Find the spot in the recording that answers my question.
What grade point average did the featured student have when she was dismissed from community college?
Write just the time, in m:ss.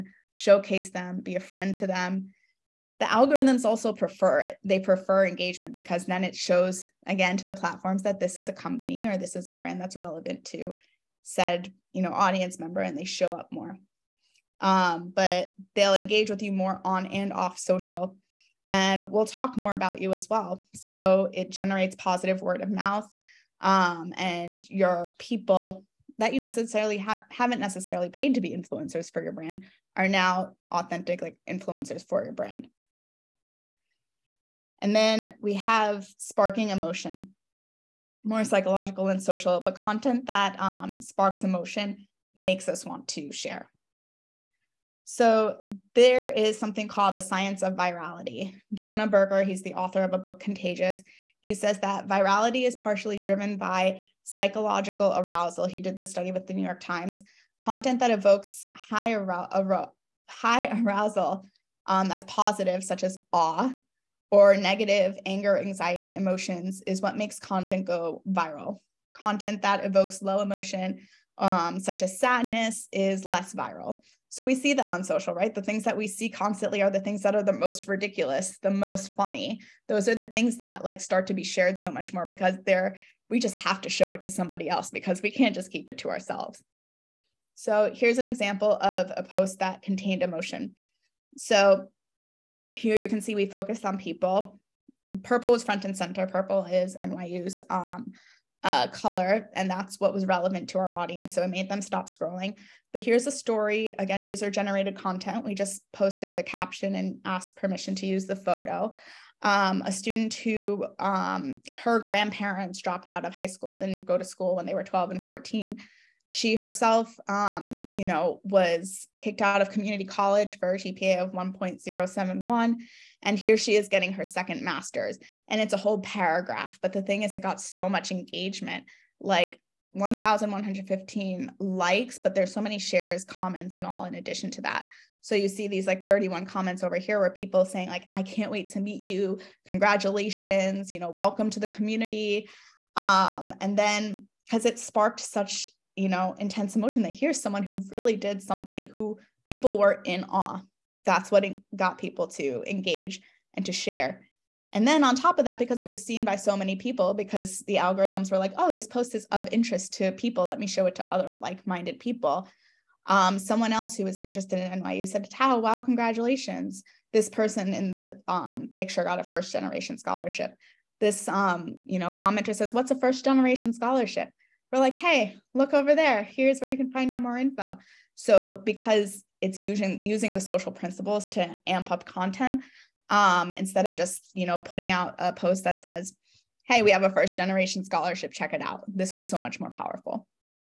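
2:01.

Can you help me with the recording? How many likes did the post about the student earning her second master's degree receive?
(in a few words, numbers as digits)
1,115.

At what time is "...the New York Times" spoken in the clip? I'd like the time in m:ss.
0:56.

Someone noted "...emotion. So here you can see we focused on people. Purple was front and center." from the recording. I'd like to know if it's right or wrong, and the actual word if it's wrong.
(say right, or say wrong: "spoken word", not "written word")
right.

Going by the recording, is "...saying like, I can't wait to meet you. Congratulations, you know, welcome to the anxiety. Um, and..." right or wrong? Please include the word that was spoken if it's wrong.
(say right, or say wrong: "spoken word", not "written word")
wrong: "community", not "anxiety".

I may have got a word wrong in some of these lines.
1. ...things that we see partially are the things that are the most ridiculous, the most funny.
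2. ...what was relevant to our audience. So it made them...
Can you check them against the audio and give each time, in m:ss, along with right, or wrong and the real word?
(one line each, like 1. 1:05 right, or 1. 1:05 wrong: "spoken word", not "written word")
1. 1:15 wrong: "constantly", not "partially"
2. 1:39 right.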